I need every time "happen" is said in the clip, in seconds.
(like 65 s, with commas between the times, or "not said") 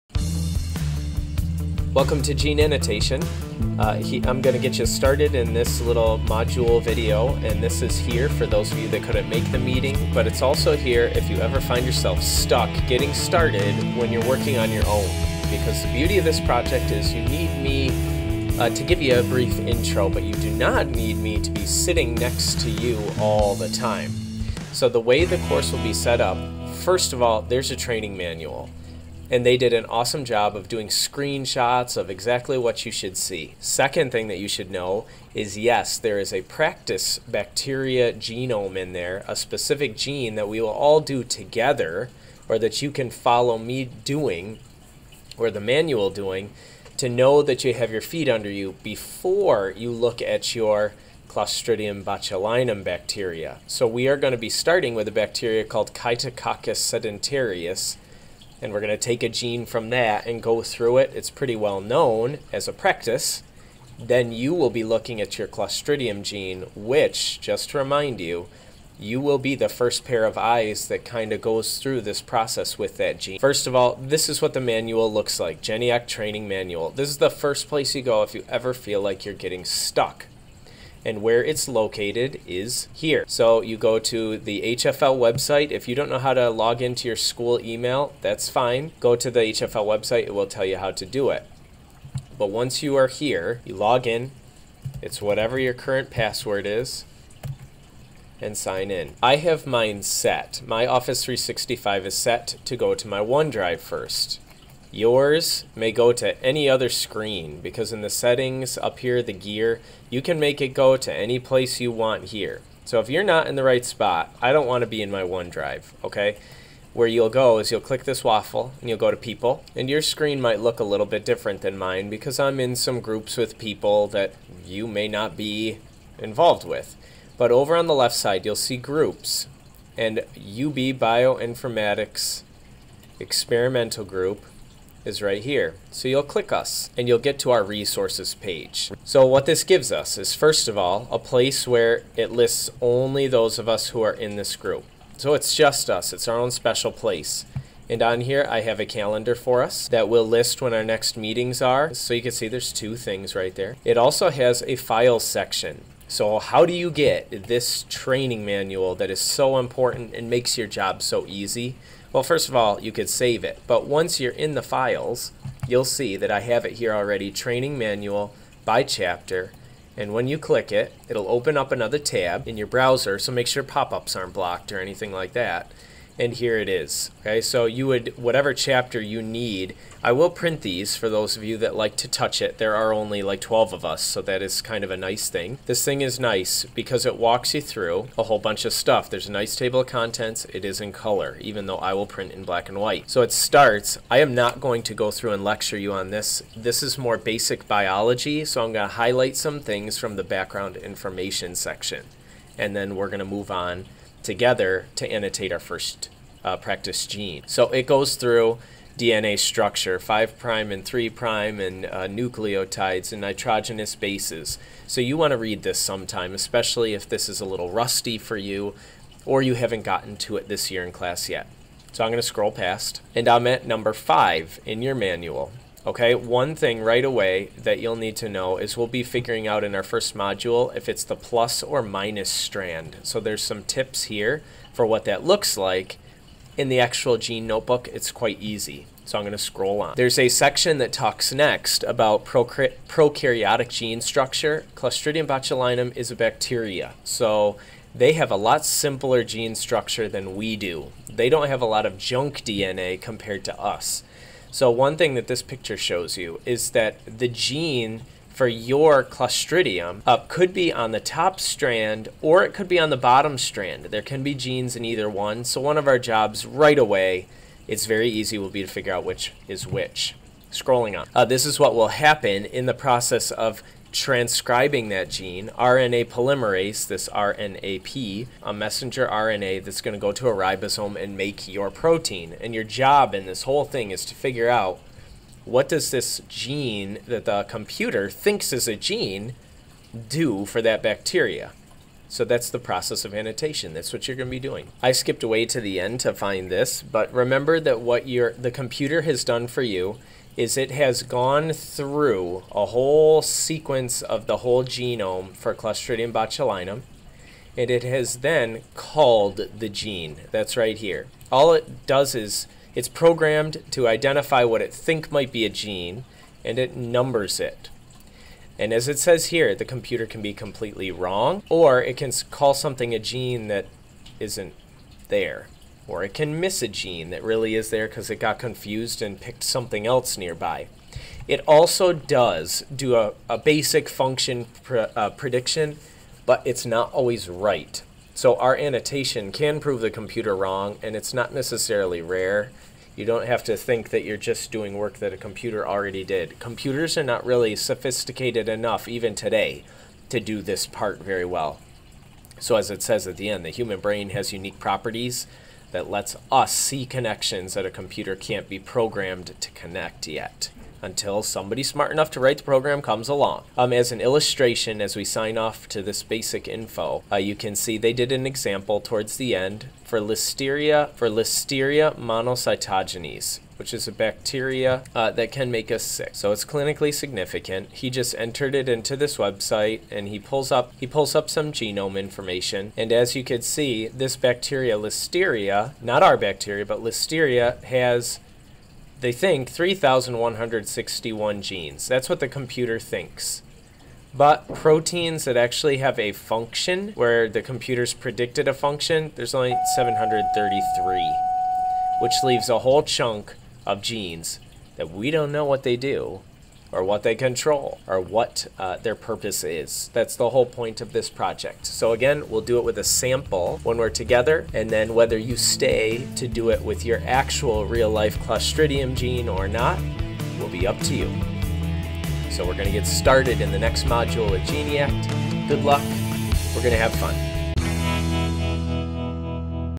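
271 s.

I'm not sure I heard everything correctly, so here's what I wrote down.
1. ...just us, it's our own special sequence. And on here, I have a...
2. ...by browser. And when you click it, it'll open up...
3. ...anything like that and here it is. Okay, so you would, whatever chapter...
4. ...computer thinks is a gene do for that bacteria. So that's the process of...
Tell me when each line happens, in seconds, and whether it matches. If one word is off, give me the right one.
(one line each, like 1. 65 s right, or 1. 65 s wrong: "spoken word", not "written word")
1. 145 s wrong: "place", not "sequence"
2. 168 s wrong: "chapter", not "browser"
3. 174 s right
4. 287 s right.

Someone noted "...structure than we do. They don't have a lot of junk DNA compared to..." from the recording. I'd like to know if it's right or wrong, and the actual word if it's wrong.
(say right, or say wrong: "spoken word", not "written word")
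right.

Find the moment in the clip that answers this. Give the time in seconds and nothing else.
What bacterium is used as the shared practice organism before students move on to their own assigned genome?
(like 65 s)
55 s.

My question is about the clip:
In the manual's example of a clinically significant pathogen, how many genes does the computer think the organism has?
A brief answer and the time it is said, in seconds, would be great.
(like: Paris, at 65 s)
3,161, at 389 s.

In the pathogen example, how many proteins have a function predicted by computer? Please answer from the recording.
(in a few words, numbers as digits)
733.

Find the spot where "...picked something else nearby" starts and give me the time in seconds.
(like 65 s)
329 s.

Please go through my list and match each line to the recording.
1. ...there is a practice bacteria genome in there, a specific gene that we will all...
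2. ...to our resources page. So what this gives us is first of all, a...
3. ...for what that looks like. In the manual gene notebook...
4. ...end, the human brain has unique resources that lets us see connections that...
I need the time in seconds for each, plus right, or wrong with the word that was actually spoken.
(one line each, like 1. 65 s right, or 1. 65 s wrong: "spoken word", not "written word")
1. 35 s right
2. 137 s right
3. 234 s wrong: "actual", not "manual"
4. 353 s wrong: "properties", not "resources".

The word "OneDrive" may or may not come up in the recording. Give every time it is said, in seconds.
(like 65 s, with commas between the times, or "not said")
103 s, 115 s.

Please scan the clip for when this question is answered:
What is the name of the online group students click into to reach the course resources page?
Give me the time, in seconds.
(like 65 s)
130 s.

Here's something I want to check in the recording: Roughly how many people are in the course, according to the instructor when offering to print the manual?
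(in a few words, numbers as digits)
12.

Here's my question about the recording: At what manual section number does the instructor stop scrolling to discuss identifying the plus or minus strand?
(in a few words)
5.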